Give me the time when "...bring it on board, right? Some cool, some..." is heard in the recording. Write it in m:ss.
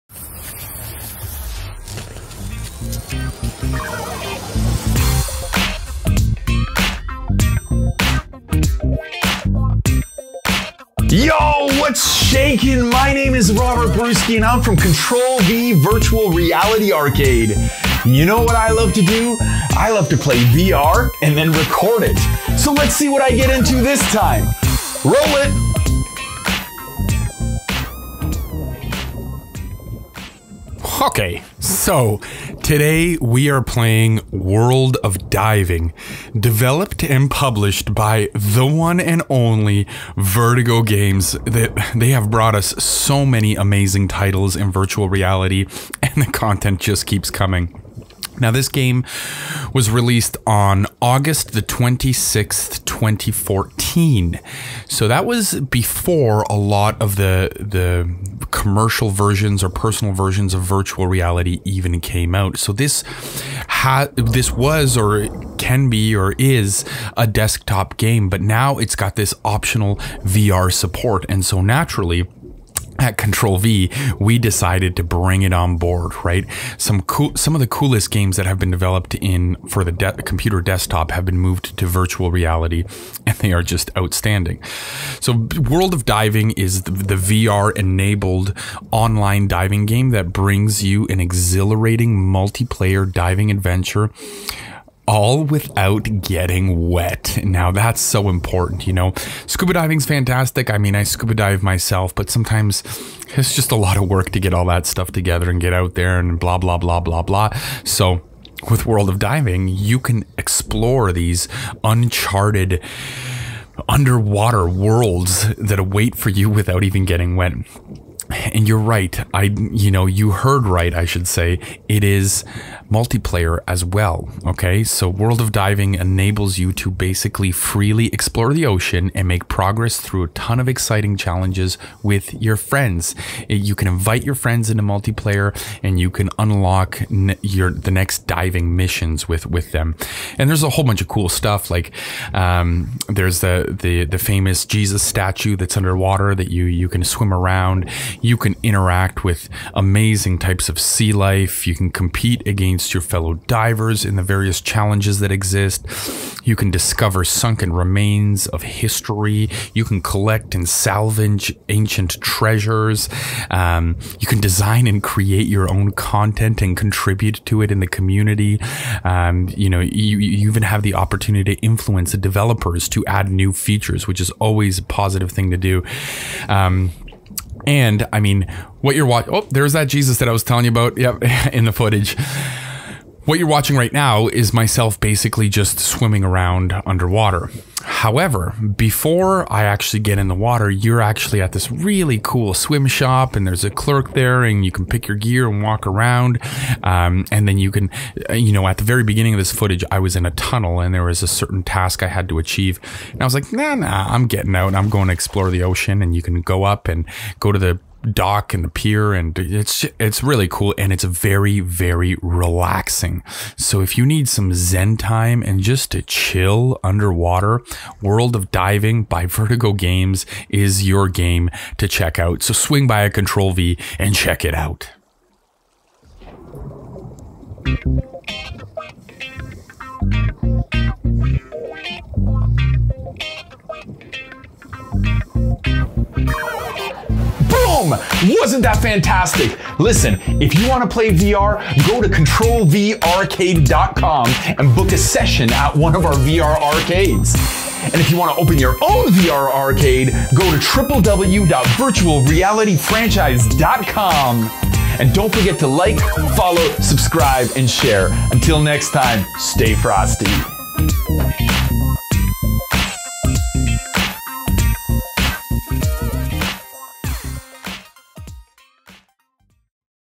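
1:15.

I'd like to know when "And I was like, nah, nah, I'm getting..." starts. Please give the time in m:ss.
3:23.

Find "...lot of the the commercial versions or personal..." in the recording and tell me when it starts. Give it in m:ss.
0:56.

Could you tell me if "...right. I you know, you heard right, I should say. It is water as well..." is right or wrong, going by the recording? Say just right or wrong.
wrong.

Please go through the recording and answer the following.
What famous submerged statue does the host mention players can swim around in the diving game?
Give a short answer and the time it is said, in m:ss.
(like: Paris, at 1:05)
Jesus statue, at 2:24.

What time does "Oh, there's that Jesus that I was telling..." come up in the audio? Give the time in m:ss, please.
2:59.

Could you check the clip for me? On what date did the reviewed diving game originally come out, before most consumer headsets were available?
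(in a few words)
August 26, 2014.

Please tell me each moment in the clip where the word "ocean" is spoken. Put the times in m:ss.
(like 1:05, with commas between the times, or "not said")
2:08, 3:25.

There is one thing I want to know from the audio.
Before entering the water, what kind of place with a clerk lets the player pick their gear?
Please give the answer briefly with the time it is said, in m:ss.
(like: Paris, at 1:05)
swim shop, at 3:12.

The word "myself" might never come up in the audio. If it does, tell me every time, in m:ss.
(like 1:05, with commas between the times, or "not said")
1:41, 3:04.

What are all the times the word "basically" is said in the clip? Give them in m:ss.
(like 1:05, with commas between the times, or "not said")
2:06, 3:04.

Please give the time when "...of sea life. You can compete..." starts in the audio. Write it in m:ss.
2:30.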